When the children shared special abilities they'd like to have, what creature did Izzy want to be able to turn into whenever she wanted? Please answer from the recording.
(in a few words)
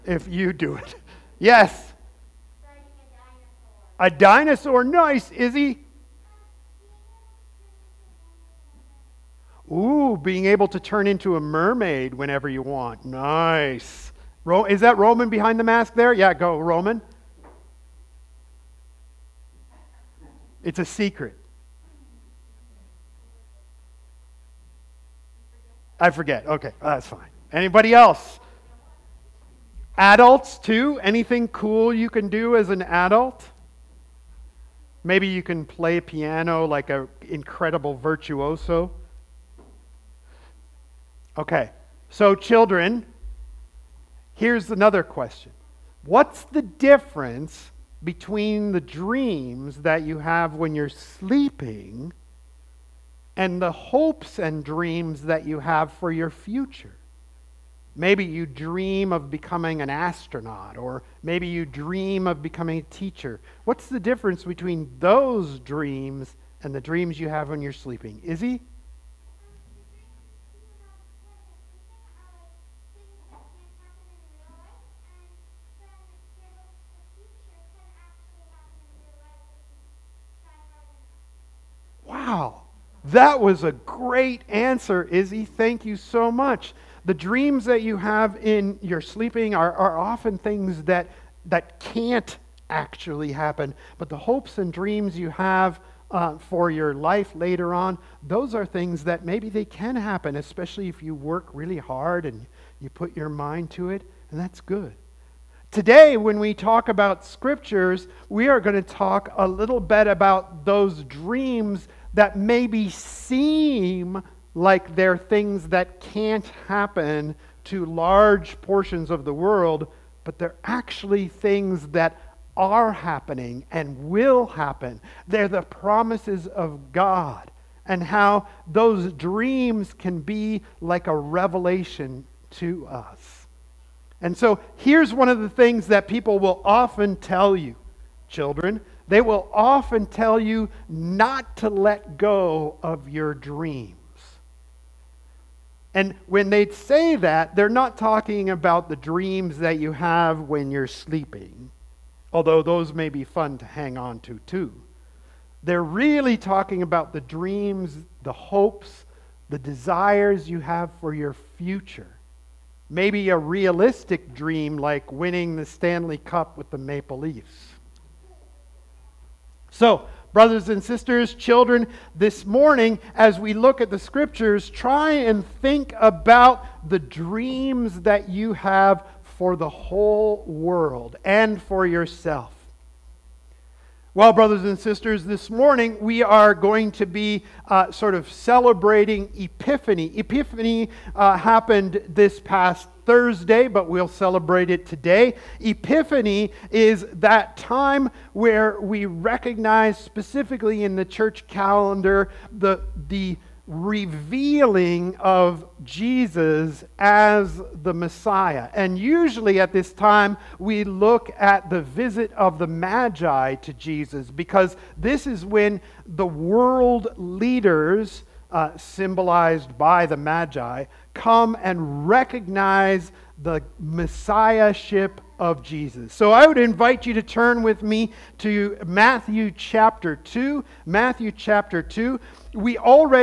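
Mermaid.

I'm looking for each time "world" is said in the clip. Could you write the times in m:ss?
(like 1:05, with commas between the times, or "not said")
1:59, 3:00, 3:36.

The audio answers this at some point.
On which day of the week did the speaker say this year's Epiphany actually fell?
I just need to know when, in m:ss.
3:13.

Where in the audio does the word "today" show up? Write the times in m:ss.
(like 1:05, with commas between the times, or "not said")
1:45, 3:14.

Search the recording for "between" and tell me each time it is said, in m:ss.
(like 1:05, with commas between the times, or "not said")
0:48, 1:04.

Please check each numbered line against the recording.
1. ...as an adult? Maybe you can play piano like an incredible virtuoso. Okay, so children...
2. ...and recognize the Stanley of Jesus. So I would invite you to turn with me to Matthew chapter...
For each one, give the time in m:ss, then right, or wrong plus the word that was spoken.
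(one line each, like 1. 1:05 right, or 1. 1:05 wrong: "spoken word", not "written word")
1. 0:32 right
2. 3:41 wrong: "Messiahship", not "Stanley".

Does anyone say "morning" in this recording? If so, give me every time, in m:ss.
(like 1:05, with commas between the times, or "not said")
2:52, 3:05.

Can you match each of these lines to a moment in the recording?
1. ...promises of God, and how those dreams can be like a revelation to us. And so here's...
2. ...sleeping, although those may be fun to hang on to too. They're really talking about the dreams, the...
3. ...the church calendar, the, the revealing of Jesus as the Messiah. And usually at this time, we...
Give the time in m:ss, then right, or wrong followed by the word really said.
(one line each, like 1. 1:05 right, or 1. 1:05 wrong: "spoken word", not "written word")
1. 2:05 right
2. 2:30 right
3. 3:20 right.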